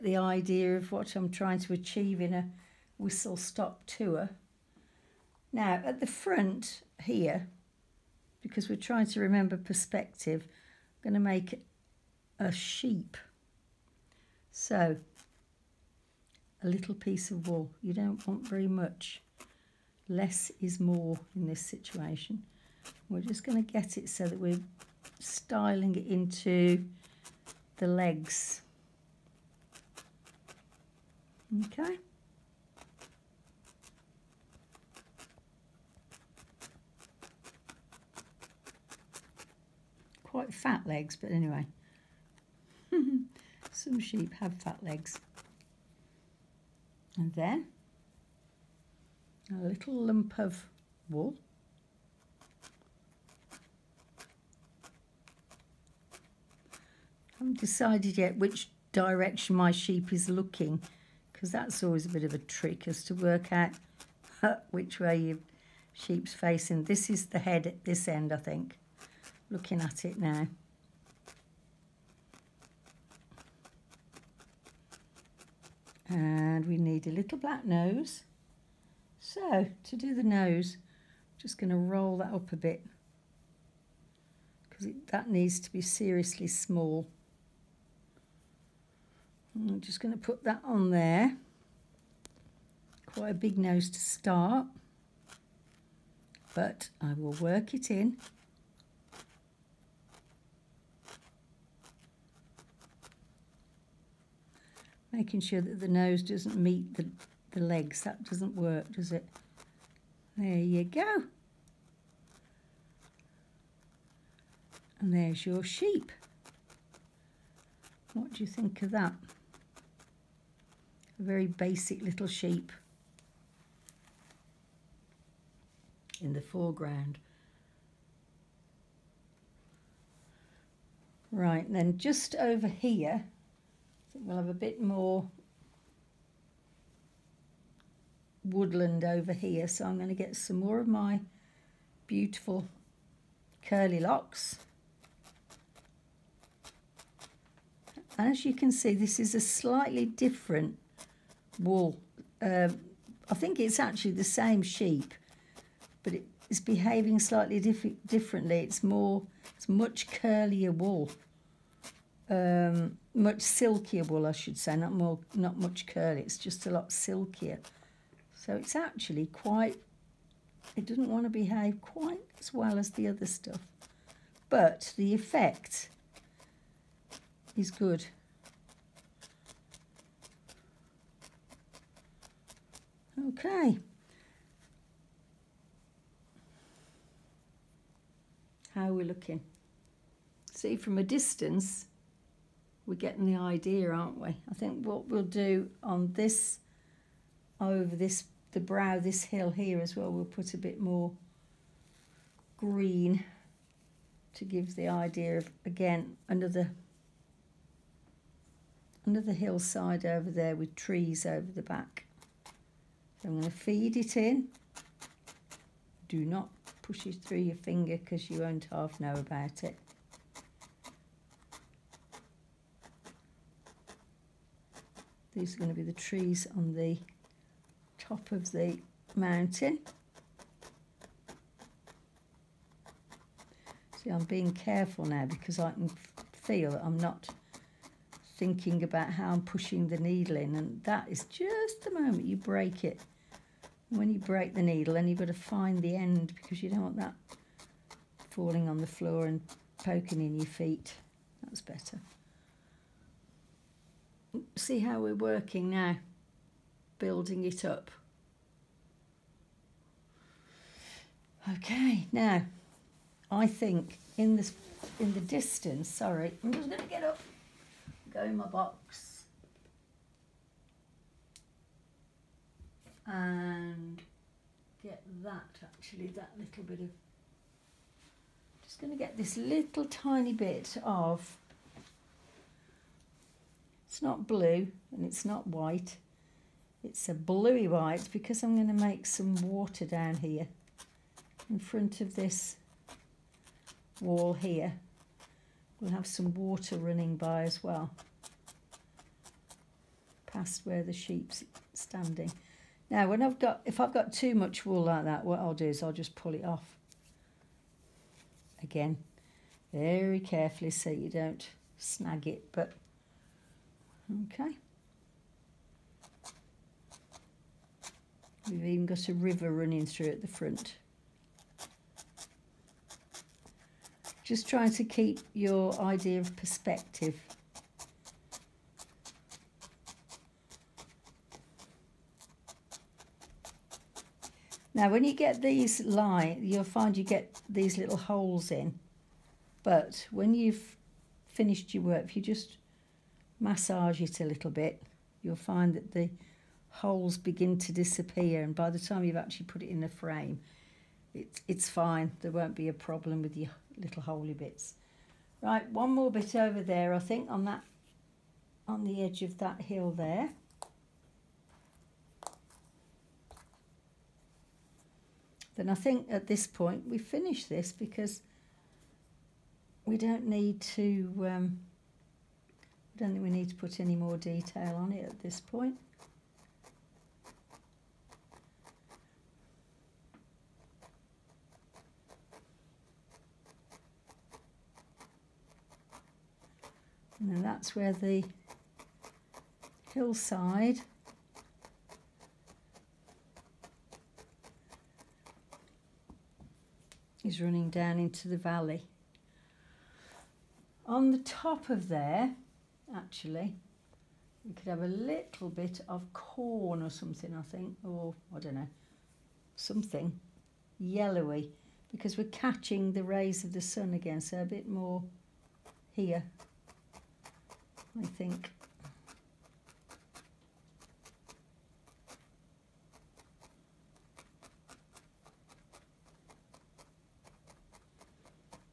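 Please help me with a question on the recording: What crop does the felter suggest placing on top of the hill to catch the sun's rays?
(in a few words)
Corn.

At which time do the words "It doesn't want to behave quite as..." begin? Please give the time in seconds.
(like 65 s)
170 s.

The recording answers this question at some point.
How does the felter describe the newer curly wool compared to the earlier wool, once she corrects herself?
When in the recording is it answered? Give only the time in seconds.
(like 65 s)
163 s.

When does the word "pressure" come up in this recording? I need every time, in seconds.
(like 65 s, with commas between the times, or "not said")
not said.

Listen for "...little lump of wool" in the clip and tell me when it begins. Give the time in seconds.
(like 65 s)
49 s.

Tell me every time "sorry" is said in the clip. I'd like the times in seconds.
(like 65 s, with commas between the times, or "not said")
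265 s.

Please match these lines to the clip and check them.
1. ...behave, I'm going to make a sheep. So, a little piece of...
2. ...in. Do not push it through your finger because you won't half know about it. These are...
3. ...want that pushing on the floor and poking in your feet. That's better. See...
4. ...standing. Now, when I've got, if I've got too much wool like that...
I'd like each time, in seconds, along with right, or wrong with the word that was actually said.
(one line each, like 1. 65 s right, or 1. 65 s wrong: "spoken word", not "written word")
1. 9 s wrong: "perspective", not "behave"
2. 214 s right
3. 246 s wrong: "falling", not "pushing"
4. 301 s right.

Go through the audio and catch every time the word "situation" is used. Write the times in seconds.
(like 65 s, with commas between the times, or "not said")
21 s.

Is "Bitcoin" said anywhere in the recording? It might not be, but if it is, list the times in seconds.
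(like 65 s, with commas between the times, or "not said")
not said.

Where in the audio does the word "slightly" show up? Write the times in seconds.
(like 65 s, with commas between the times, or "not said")
149 s, 157 s.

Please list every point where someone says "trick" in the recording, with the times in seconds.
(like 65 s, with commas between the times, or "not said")
62 s.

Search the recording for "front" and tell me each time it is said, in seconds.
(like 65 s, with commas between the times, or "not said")
6 s, 291 s, 320 s.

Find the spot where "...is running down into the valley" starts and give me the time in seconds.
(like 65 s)
397 s.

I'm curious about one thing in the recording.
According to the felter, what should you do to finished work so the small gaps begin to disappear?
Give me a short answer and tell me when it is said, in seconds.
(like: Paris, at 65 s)
Massage it, at 343 s.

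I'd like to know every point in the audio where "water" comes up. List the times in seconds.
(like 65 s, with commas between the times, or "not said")
289 s, 296 s.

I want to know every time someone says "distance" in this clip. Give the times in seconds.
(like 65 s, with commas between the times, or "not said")
191 s, 265 s.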